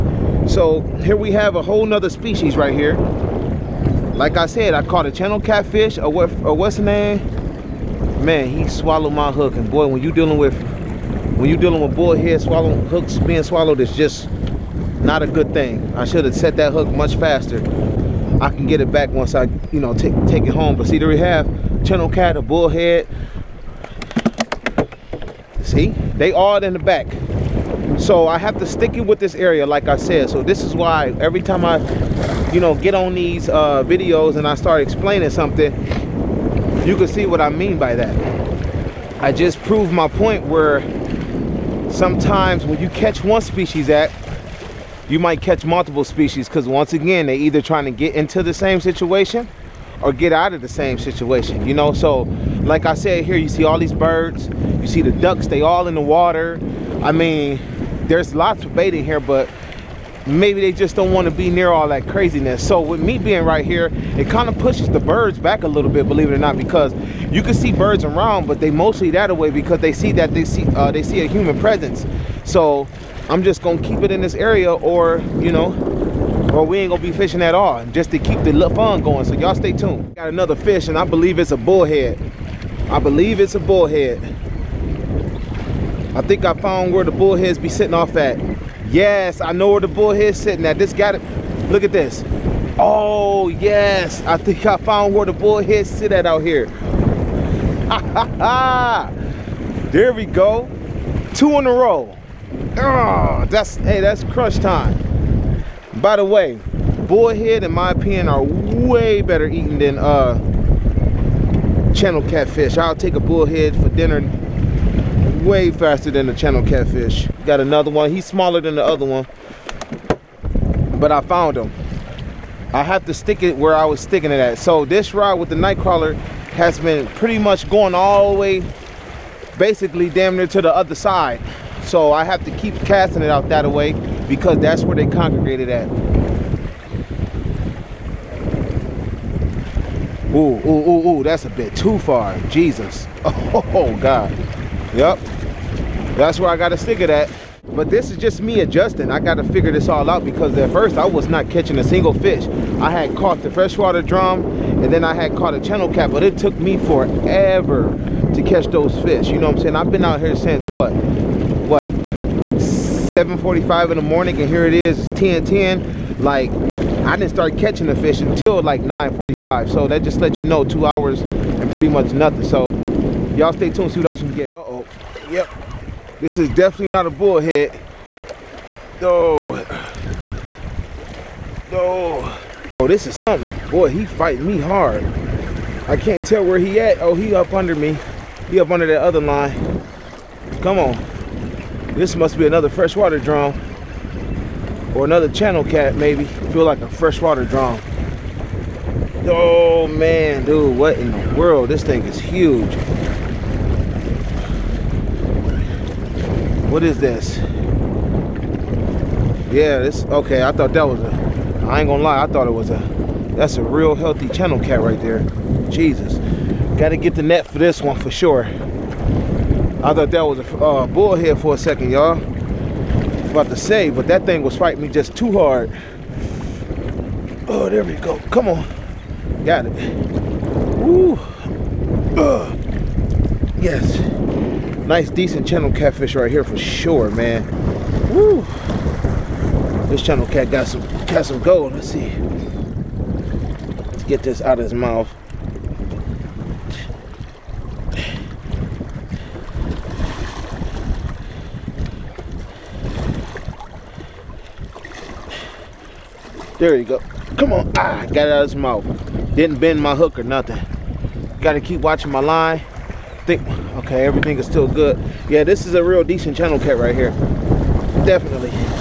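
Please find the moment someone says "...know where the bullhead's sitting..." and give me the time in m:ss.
1:29.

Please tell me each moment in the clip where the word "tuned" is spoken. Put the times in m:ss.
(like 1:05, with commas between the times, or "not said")
1:19, 2:53.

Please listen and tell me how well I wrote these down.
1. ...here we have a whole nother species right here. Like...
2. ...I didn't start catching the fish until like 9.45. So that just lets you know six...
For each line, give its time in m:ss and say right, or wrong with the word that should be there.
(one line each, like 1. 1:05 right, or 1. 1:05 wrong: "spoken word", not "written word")
1. 0:00 right
2. 2:46 wrong: "two", not "six".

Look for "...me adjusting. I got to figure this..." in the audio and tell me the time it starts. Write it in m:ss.
2:28.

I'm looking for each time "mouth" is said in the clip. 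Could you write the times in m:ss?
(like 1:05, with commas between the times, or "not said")
4:04, 4:18.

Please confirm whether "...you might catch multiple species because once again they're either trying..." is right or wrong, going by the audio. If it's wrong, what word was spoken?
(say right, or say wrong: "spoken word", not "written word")
right.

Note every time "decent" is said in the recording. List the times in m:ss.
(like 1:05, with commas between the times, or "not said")
3:55, 4:26.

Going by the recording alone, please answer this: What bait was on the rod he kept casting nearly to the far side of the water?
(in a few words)
Nightcrawler.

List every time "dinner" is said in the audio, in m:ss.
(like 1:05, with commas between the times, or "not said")
1:53.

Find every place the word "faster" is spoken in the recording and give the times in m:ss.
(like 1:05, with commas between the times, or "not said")
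0:17, 1:55.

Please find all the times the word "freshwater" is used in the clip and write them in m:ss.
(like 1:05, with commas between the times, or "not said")
2:33, 3:12, 3:16.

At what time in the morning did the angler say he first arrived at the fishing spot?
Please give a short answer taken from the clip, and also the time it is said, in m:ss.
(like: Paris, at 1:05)
7:45, at 2:42.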